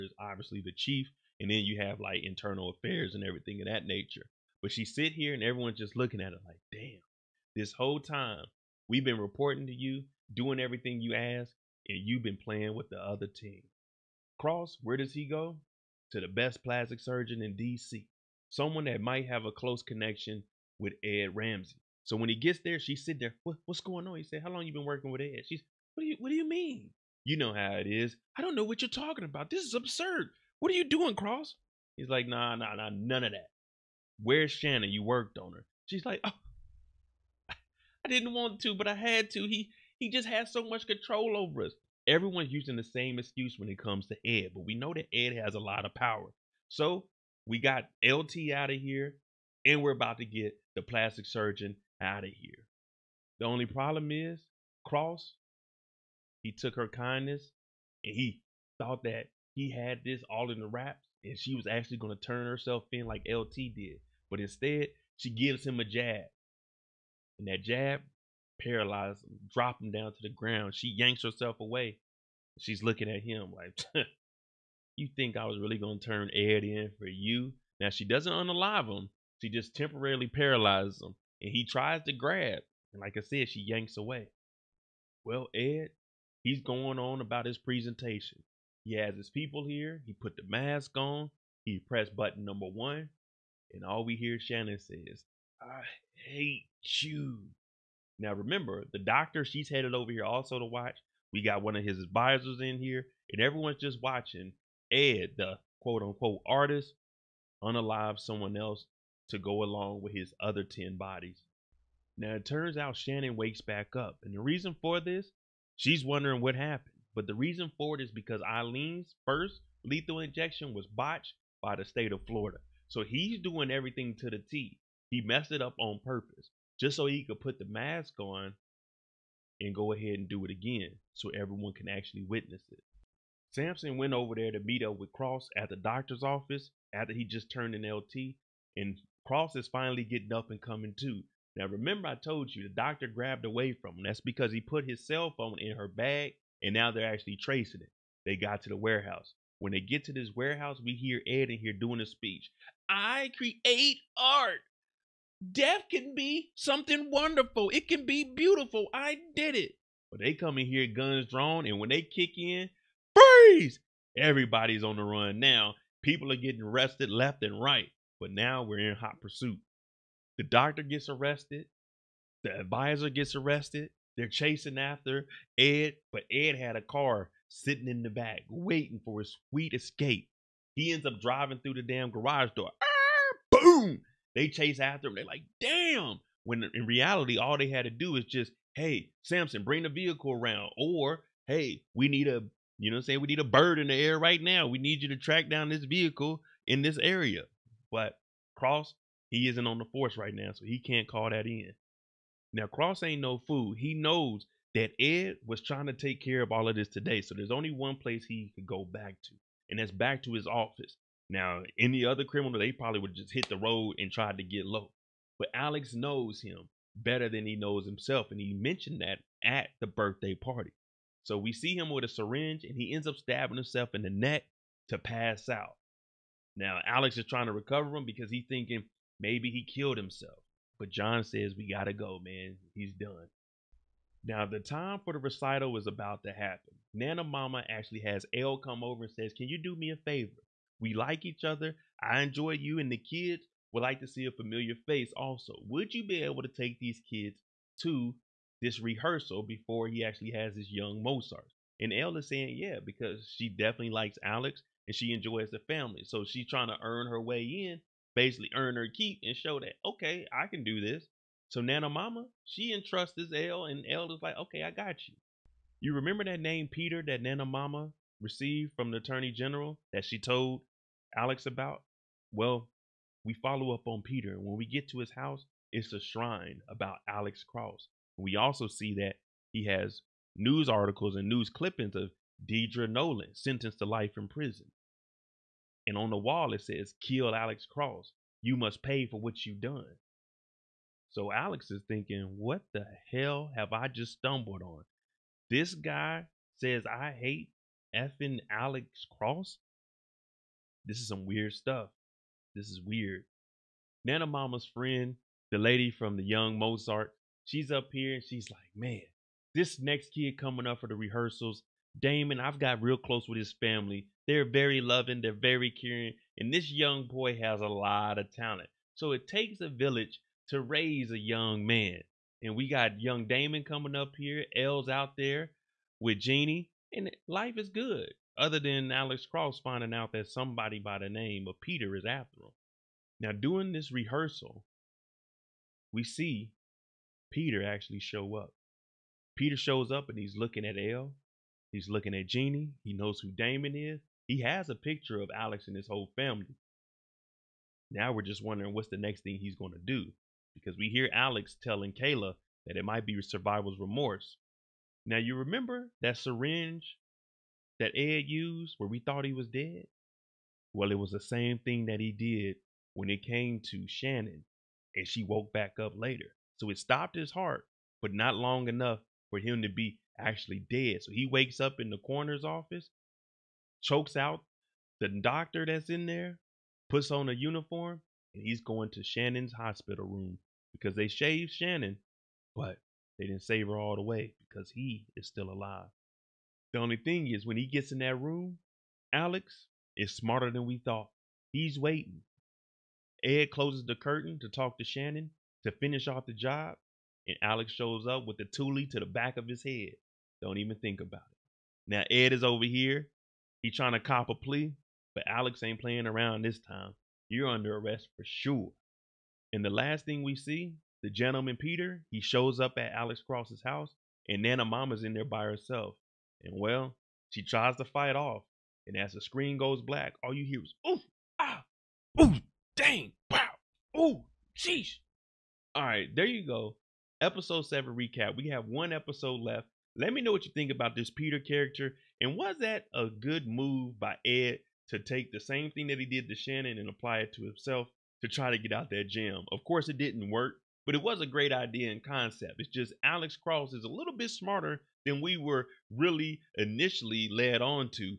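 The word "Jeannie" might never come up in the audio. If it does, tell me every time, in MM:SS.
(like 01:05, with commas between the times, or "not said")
05:26, 05:42.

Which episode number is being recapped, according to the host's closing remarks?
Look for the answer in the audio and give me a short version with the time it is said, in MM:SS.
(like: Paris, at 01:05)
7, at 07:07.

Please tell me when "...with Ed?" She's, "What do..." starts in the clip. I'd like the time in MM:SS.
00:25.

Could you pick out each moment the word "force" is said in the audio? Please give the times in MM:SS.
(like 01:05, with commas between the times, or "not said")
03:19.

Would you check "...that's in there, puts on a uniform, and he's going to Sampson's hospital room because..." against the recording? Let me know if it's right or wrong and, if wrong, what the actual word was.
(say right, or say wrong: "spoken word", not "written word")
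wrong: "Shannon", not "Sampson".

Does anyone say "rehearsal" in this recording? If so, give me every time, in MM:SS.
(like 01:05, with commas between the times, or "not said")
04:08, 05:10, 05:33.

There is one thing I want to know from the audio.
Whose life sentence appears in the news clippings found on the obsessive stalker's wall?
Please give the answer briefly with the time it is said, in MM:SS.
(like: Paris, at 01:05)
Deidre Nolan, at 04:42.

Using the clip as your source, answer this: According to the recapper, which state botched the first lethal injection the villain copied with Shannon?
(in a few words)
Florida.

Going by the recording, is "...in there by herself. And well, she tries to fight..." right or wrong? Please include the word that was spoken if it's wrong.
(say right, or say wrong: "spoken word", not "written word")
right.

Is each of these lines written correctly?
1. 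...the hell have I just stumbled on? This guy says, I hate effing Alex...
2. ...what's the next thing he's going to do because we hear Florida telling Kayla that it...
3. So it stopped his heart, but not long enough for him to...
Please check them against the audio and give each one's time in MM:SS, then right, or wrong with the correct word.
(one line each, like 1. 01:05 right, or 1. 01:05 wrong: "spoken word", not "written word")
1. 04:52 right
2. 05:48 wrong: "Alex", not "Florida"
3. 06:06 right.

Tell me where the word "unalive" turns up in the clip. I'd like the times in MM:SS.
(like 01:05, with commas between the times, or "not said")
01:18, 01:47.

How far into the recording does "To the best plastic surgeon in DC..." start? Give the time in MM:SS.
00:16.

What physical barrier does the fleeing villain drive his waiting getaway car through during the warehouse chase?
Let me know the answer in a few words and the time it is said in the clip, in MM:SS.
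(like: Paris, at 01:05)
Garage door, at 03:02.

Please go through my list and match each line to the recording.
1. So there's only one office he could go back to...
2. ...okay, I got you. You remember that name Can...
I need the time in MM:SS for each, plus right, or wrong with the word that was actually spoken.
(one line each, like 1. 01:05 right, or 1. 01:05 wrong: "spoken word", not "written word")
1. 03:27 wrong: "place", not "office"
2. 04:24 wrong: "Peter", not "Can".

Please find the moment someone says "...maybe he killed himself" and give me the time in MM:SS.
03:49.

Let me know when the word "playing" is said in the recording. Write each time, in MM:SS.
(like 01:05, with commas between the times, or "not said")
00:12, 06:45.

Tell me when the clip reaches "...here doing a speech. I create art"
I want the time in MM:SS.
02:31.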